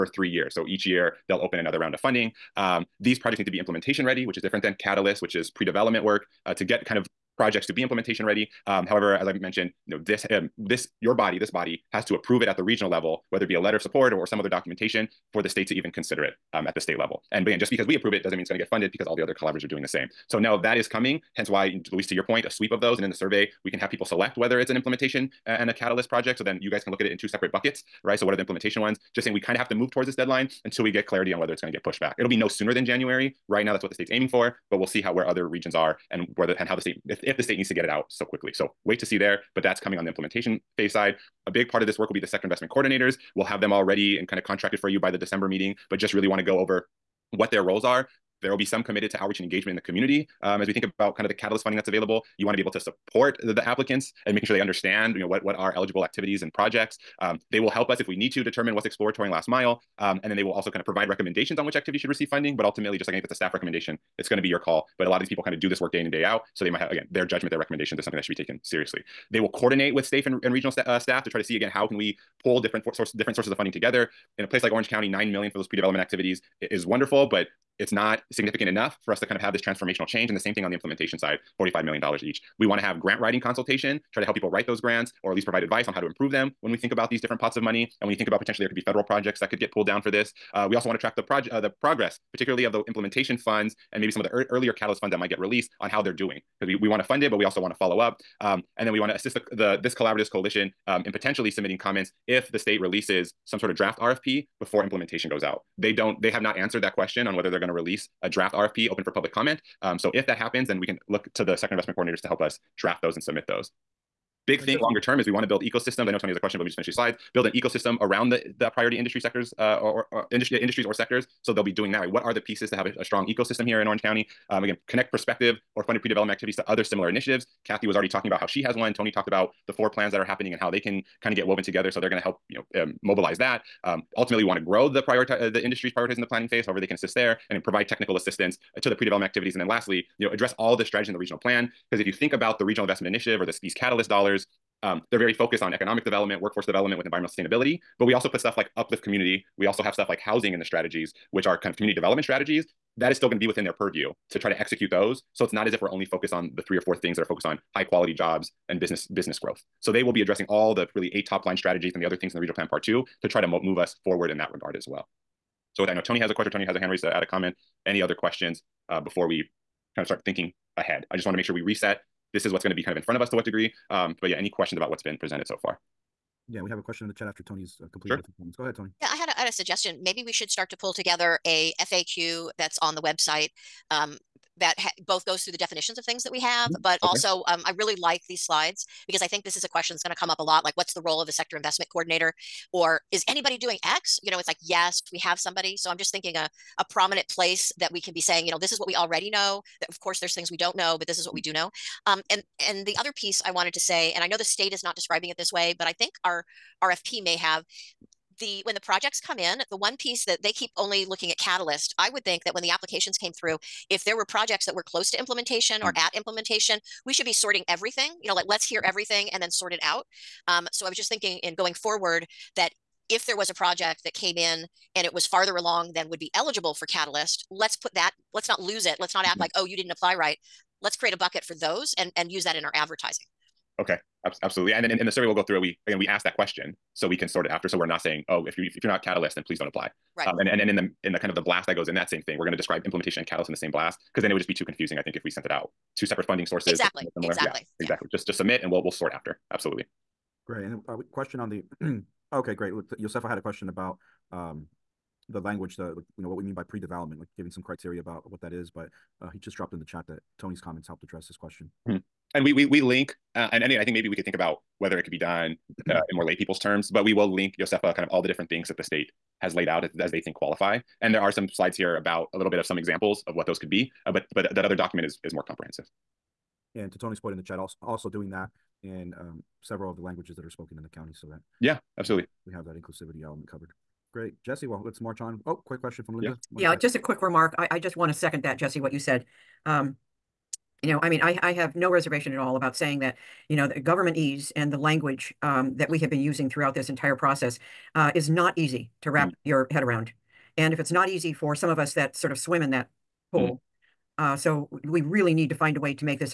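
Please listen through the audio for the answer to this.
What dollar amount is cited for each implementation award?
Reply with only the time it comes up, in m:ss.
1:21.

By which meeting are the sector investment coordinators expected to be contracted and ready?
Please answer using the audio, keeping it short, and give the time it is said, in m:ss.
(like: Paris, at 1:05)
December meeting, at 0:45.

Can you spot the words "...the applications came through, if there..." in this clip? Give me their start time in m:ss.
3:32.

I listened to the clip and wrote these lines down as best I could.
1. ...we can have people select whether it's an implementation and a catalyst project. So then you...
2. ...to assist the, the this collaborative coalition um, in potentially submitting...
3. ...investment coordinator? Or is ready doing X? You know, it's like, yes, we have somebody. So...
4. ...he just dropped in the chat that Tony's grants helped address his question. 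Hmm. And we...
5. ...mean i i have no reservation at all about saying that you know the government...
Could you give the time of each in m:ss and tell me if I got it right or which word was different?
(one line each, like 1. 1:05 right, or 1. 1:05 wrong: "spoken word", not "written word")
1. 0:23 right
2. 1:39 right
3. 3:11 wrong: "anybody", not "ready"
4. 4:19 wrong: "comments", not "grants"
5. 4:51 right.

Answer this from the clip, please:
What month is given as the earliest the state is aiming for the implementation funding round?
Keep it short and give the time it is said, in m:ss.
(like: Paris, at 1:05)
January, at 0:32.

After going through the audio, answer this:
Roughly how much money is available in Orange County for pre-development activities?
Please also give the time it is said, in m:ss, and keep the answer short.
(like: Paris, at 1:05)
9 million, at 1:15.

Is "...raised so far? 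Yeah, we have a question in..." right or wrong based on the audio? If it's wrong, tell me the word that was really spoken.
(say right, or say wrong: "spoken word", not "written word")
wrong: "presented", not "raised".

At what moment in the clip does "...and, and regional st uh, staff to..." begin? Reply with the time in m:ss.
1:10.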